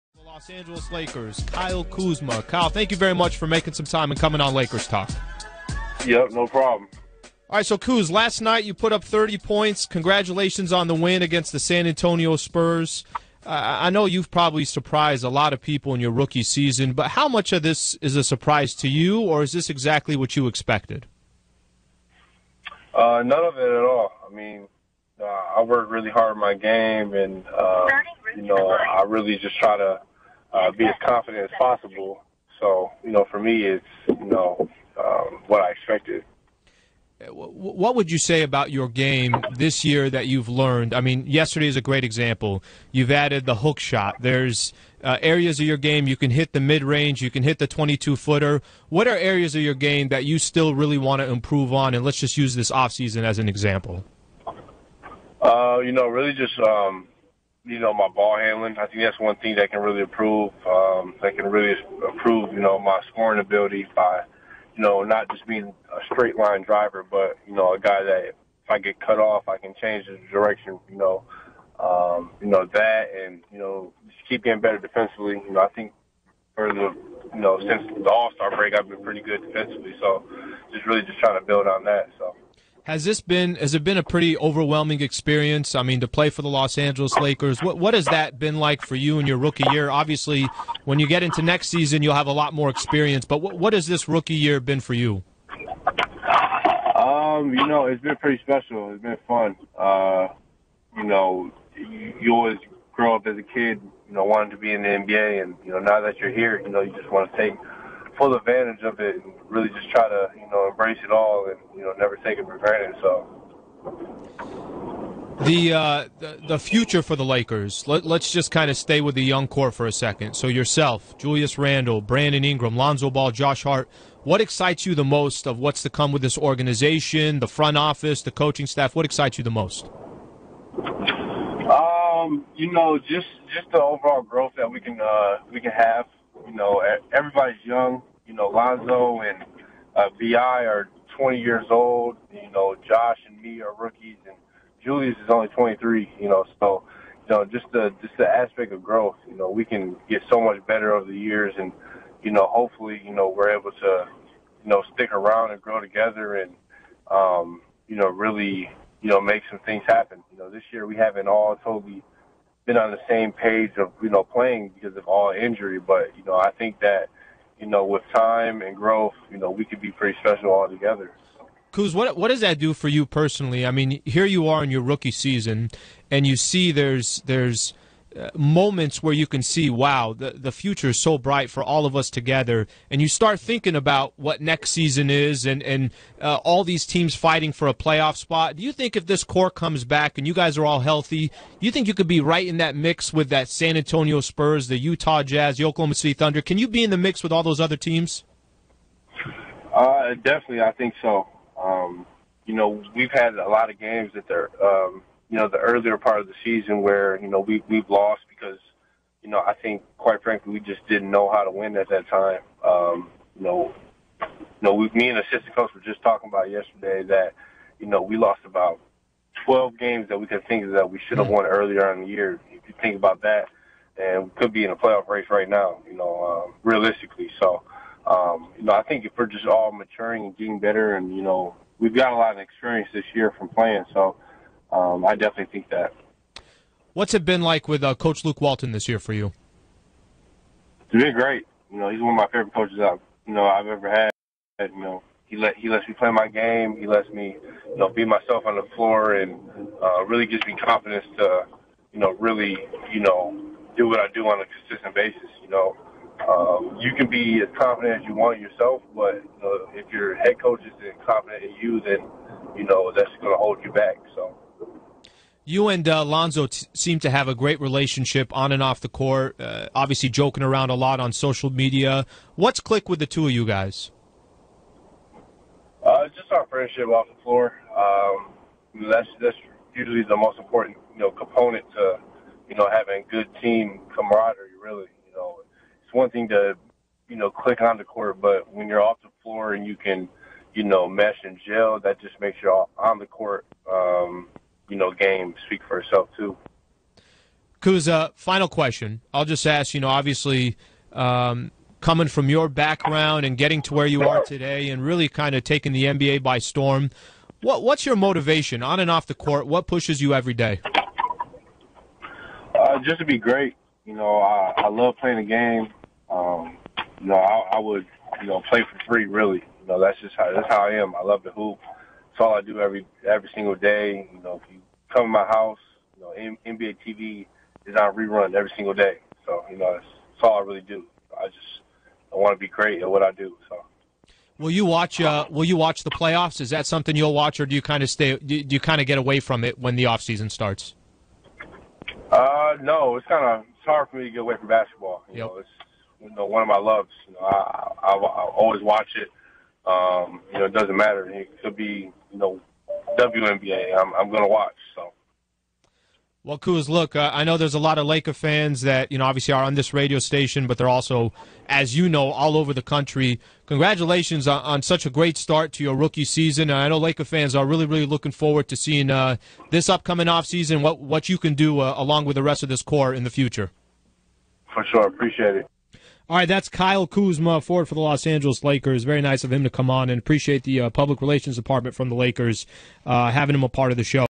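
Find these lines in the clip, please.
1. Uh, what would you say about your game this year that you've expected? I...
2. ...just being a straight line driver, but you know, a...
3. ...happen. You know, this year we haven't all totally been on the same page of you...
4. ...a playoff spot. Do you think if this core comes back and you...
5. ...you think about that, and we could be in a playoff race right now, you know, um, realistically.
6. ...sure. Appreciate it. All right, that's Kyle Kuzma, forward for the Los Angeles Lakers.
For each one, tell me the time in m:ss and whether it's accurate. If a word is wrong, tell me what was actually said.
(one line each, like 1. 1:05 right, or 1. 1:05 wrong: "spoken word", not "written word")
1. 0:37 wrong: "learned", not "expected"
2. 1:05 right
3. 2:39 right
4. 3:07 right
5. 3:42 right
6. 6:14 right.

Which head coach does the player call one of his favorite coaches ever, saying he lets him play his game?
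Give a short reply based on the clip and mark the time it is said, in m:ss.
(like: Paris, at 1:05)
Luke Walton, at 3:58.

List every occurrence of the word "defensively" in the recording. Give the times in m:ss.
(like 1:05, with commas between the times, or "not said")
1:14, 1:19.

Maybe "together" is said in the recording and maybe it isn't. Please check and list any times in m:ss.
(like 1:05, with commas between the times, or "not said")
2:35, 2:50, 3:02.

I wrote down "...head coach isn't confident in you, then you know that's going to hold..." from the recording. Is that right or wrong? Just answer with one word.
right.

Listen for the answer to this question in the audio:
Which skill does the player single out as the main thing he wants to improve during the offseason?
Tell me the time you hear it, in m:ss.
0:58.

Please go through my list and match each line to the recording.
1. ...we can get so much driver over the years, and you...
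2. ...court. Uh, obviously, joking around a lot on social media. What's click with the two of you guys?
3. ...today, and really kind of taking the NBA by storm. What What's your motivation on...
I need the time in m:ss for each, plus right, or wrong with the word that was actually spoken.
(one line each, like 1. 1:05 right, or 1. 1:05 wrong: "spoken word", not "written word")
1. 2:29 wrong: "better", not "driver"
2. 4:28 right
3. 5:04 right.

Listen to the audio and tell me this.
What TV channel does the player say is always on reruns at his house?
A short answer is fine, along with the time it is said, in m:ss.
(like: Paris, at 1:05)
NBA TV, at 5:26.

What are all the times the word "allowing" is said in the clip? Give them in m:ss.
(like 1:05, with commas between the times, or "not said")
not said.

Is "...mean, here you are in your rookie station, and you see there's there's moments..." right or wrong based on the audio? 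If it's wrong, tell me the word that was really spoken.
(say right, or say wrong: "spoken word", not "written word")
wrong: "season", not "station".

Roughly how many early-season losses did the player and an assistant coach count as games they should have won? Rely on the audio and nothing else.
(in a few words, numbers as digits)
12.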